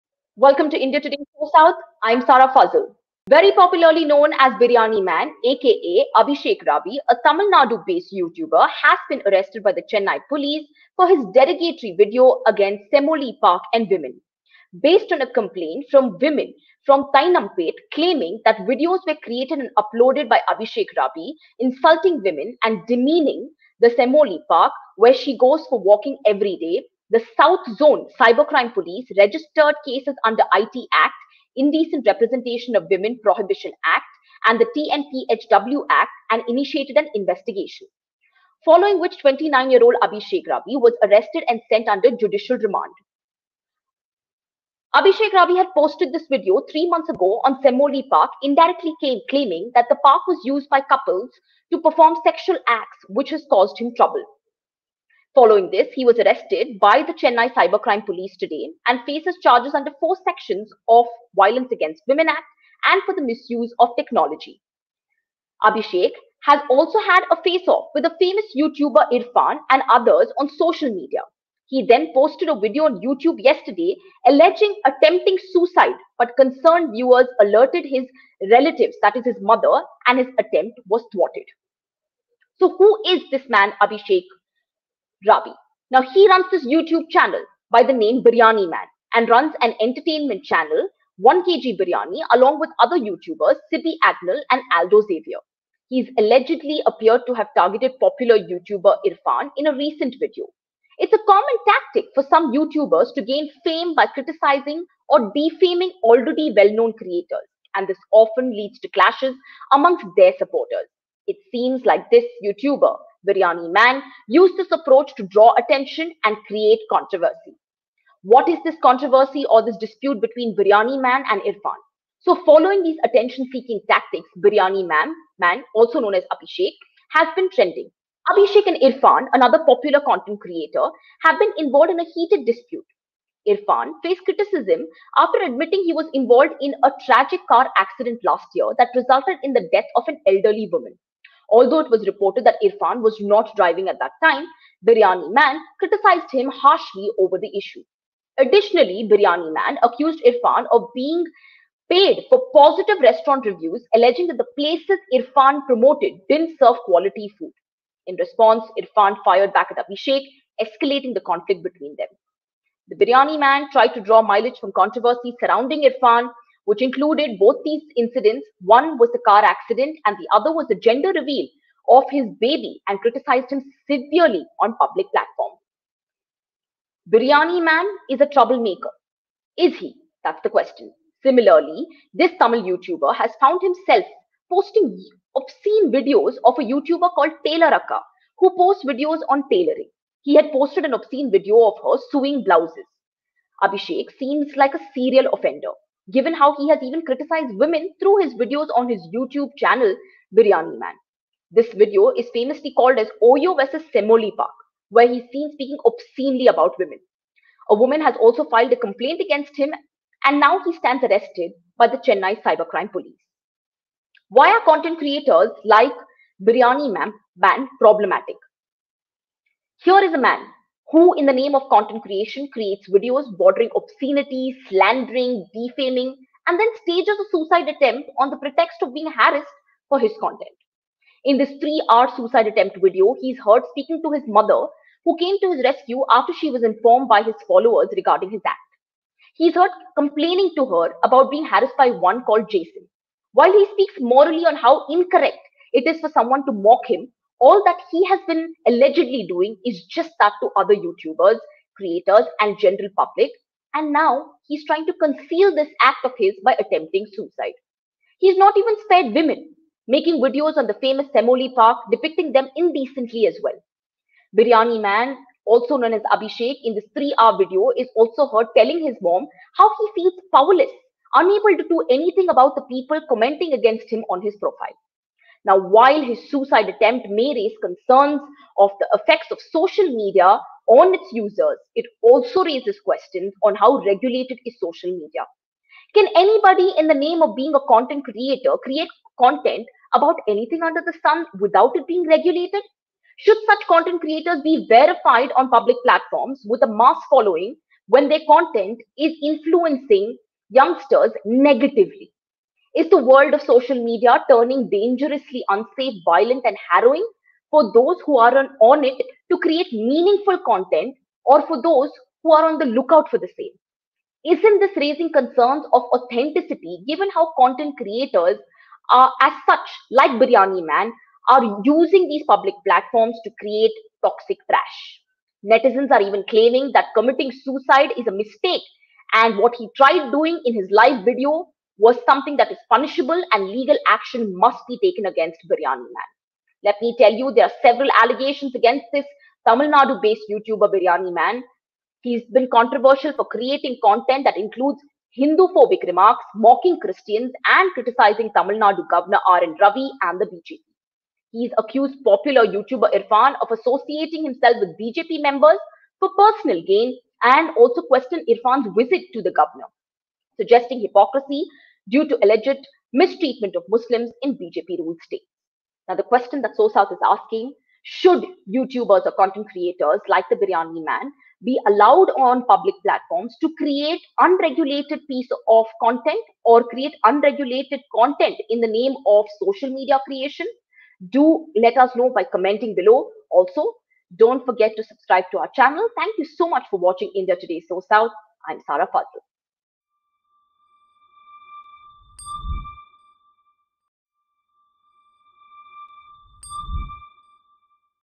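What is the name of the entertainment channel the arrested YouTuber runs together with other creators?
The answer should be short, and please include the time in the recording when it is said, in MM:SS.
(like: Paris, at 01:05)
1kg Biryani, at 01:31.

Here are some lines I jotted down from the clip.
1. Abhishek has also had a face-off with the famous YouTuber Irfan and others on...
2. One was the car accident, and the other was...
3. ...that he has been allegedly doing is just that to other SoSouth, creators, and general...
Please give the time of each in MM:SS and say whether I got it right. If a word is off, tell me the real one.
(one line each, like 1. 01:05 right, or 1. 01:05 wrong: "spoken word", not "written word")
1. 01:05 right
2. 02:48 right
3. 04:07 wrong: "YouTubers", not "SoSouth".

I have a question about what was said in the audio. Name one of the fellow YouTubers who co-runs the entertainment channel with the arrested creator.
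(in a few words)
Sibi Agnel.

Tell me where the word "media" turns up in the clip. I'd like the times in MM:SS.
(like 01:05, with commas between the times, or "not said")
01:10, 04:39, 04:44, 05:03, 06:19.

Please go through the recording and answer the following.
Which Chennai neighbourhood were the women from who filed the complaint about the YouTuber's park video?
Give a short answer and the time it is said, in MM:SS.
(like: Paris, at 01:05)
Teynampet, at 00:17.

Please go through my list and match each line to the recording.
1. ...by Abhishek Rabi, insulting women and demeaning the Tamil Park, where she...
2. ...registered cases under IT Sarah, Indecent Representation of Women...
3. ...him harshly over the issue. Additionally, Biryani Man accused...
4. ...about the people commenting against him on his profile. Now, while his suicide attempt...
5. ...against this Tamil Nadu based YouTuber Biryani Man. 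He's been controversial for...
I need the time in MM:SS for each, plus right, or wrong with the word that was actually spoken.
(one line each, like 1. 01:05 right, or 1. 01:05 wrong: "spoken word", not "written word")
1. 00:20 wrong: "Semmozhi", not "Tamil"
2. 00:29 wrong: "Act", not "Sarah"
3. 02:26 right
4. 04:32 right
5. 05:38 right.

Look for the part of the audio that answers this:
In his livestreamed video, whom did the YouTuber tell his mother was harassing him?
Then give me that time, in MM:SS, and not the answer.
04:02.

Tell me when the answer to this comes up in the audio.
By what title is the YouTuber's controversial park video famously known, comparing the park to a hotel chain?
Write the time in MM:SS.
03:23.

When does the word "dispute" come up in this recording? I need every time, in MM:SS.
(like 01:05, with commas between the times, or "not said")
01:59, 02:12.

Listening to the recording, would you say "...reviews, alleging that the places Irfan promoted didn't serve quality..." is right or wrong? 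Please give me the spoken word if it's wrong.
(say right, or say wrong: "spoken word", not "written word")
right.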